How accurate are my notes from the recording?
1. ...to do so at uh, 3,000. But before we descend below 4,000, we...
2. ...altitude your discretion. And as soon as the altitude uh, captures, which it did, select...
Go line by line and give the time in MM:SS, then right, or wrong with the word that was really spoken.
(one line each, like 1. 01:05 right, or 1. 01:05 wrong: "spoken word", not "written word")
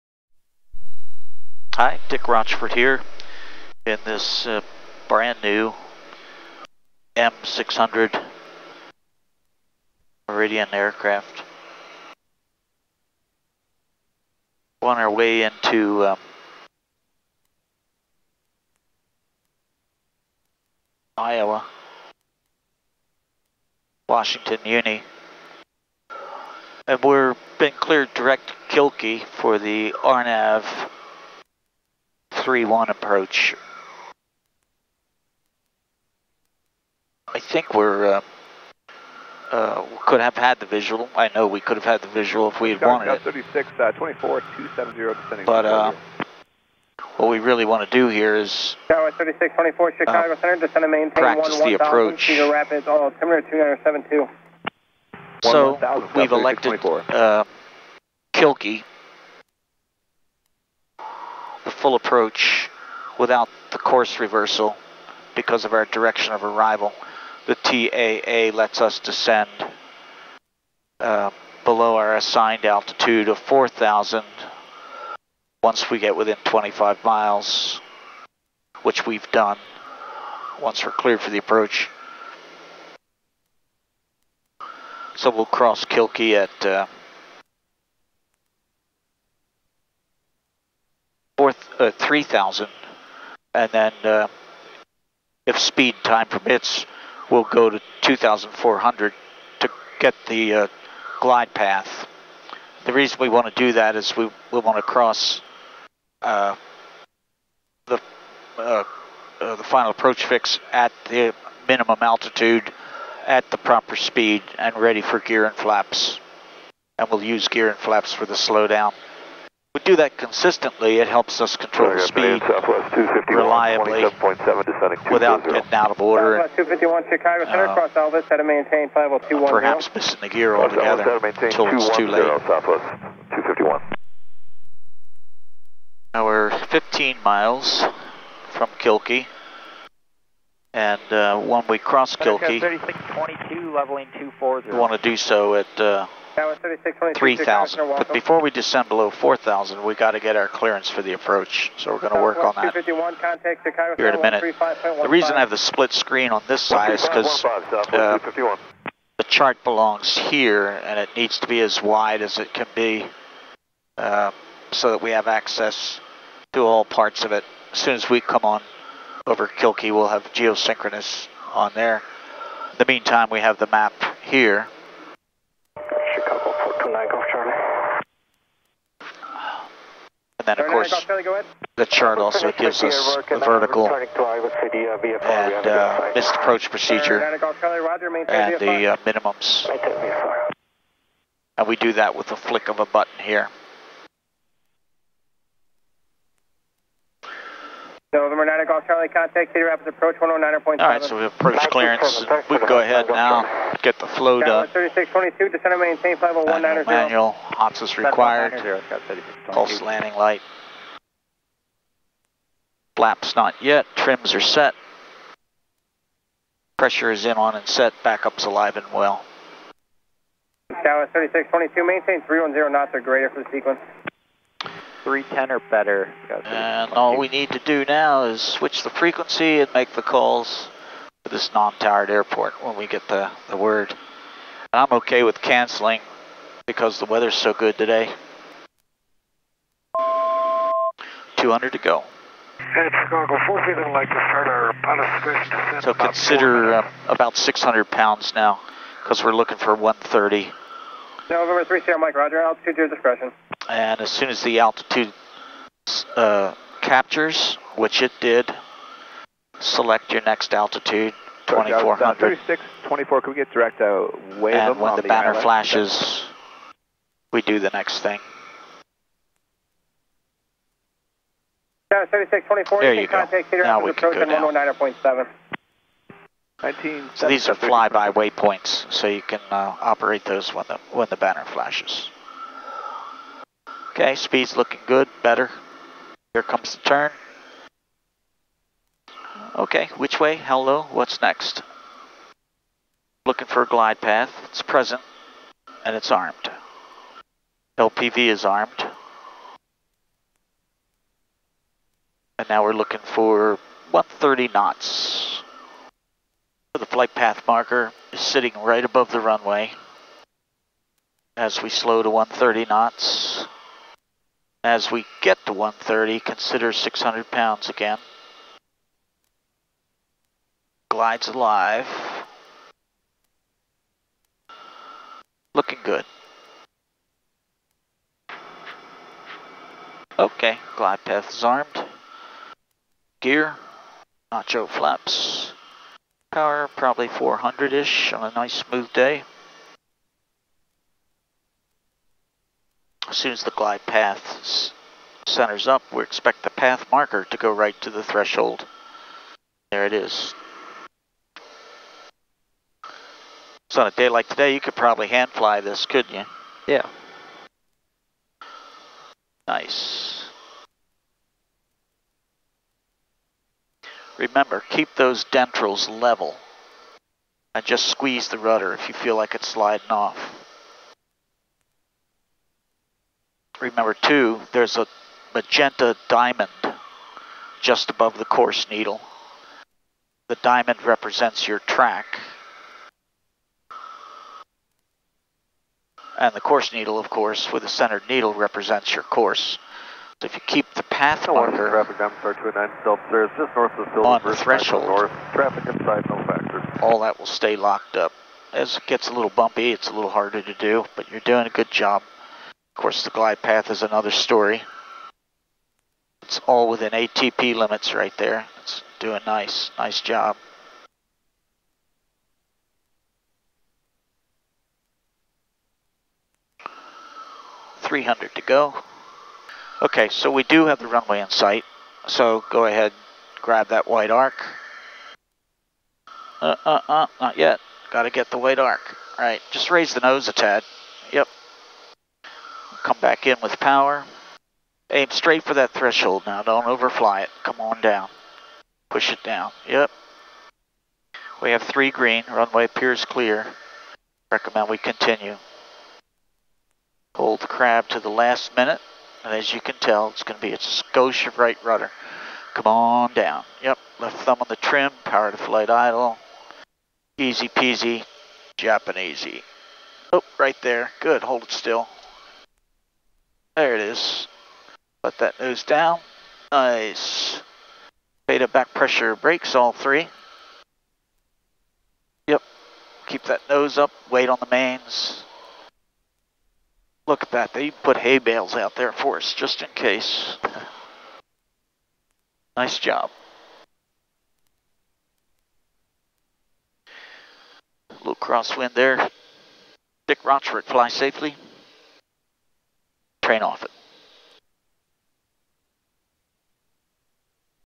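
1. 02:24 right
2. 04:12 right.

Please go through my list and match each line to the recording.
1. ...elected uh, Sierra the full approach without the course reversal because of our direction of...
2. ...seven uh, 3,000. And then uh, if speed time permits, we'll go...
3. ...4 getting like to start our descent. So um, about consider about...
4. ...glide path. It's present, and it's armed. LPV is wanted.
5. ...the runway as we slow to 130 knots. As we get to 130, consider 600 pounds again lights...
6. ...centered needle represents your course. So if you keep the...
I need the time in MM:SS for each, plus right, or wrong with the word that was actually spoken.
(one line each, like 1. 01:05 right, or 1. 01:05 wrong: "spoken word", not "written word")
1. 00:56 wrong: "Kilkee", not "Sierra"
2. 01:31 wrong: "four", not "seven"
3. 04:03 wrong: "feeling", not "getting"
4. 04:53 wrong: "armed", not "wanted"
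5. 05:09 right
6. 06:27 right.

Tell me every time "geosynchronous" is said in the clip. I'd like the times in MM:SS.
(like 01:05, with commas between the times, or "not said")
02:50.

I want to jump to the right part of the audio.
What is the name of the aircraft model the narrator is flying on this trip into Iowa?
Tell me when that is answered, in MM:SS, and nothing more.
00:07.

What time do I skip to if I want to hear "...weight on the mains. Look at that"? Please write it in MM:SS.
07:54.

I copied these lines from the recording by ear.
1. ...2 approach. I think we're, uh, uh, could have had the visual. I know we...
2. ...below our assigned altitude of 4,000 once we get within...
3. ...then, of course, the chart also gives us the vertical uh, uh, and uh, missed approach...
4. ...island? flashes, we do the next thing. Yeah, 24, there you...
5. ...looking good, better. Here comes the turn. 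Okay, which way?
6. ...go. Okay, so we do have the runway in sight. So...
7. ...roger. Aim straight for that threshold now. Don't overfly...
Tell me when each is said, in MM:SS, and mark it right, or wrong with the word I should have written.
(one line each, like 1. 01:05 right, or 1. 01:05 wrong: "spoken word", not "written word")
1. 00:32 wrong: "3", not "2"
2. 01:11 right
3. 03:00 right
4. 04:25 right
5. 04:44 right
6. 06:58 right
7. 07:13 wrong: "power", not "roger".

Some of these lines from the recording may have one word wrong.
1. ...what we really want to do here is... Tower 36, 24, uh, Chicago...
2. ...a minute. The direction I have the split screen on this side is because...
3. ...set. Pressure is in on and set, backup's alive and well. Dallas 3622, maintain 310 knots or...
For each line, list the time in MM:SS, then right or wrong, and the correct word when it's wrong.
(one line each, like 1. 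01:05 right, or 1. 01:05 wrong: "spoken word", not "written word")
1. 00:47 right
2. 02:34 wrong: "reason", not "direction"
3. 03:34 right.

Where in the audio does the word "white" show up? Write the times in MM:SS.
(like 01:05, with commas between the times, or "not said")
07:03, 07:08.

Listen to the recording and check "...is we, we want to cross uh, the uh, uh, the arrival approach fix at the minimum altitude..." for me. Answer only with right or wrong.
wrong.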